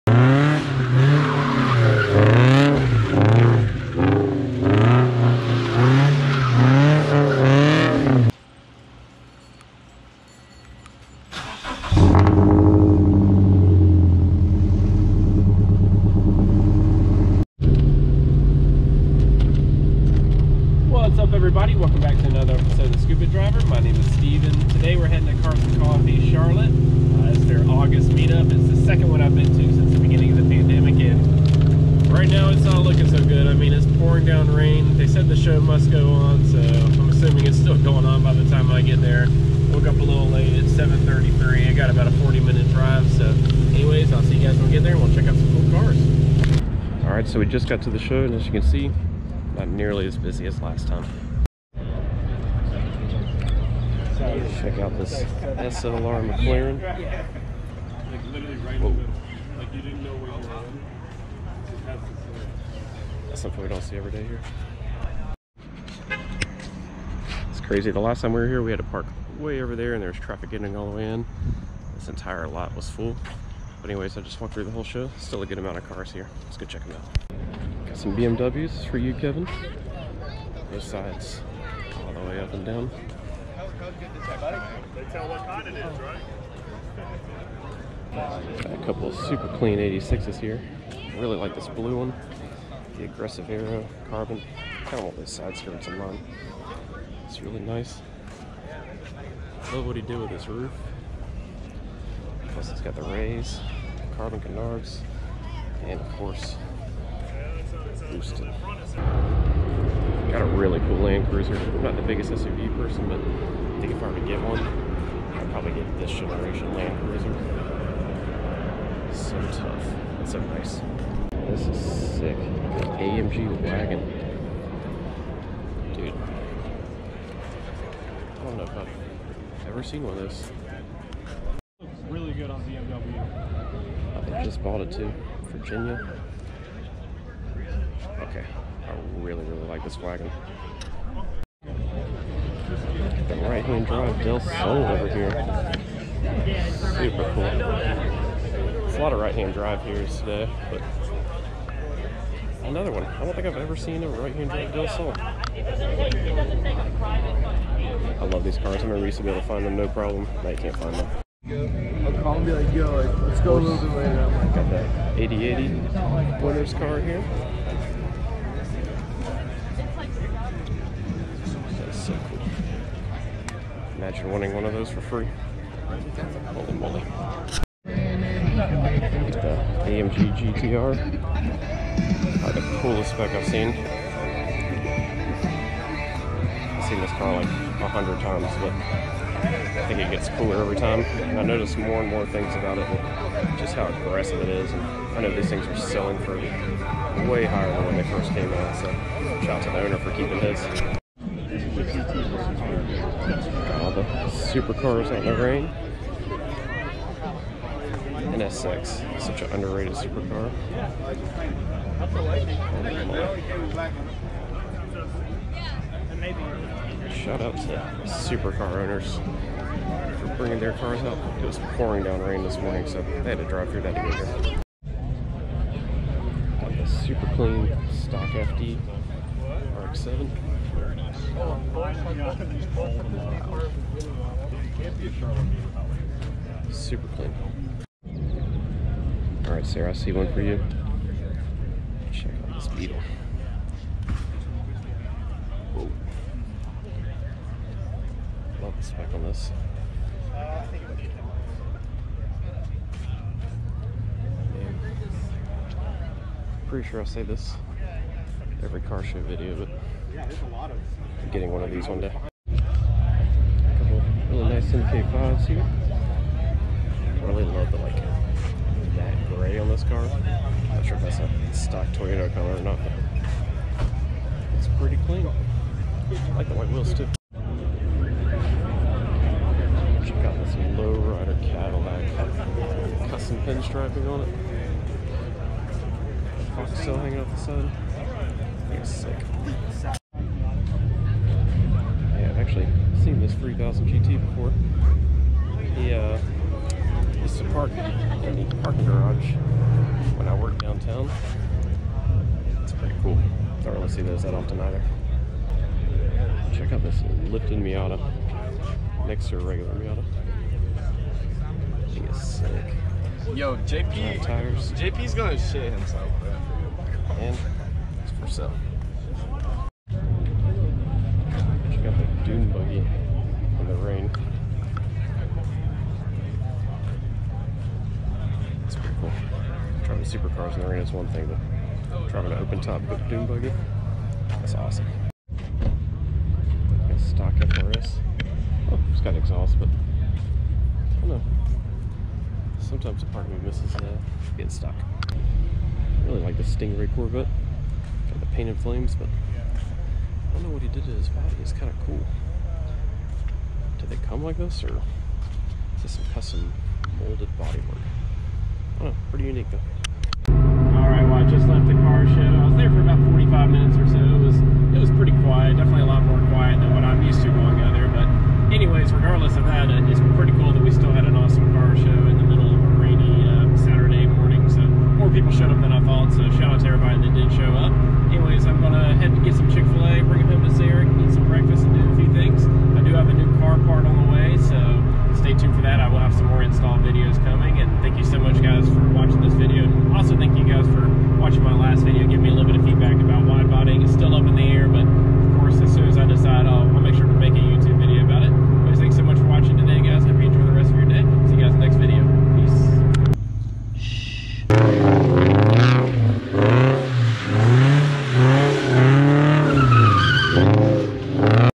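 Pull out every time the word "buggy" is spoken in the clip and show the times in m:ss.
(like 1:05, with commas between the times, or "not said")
5:22, 5:33.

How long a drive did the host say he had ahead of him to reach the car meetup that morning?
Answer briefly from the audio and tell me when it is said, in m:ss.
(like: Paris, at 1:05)
40 minutes, at 0:42.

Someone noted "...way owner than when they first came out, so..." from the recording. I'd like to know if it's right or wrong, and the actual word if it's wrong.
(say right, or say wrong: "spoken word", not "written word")
wrong: "higher", not "owner".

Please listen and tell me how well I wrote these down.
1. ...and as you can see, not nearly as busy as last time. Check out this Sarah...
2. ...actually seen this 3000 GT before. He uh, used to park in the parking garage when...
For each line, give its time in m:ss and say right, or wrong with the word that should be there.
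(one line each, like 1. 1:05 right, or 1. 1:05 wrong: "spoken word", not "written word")
1. 0:48 wrong: "SLR", not "Sarah"
2. 4:52 right.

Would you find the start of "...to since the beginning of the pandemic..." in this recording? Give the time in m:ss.
0:29.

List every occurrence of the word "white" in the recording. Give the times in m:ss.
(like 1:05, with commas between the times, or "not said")
4:36.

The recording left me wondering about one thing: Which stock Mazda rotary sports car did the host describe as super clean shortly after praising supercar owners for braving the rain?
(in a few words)
FD RX-7.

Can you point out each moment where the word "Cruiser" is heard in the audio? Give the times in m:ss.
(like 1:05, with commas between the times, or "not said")
1:51, 1:56.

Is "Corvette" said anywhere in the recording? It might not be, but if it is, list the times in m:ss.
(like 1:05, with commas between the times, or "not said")
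5:46.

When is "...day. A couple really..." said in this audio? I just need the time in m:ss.
4:21.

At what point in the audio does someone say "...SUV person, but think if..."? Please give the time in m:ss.
1:52.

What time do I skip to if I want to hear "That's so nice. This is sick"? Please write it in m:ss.
2:00.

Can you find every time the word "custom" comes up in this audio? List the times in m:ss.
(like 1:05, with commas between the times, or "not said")
4:43, 5:56.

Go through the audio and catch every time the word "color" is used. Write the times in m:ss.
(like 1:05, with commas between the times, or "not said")
4:32.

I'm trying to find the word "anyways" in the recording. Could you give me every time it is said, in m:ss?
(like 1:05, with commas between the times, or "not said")
0:43, 1:13.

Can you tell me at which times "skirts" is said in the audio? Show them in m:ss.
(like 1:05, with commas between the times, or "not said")
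1:35.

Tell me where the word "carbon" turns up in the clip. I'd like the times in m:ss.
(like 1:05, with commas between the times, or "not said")
1:34, 1:44.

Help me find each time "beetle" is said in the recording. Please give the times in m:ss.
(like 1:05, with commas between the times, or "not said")
4:02.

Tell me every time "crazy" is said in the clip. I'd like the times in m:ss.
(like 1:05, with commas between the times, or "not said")
1:07.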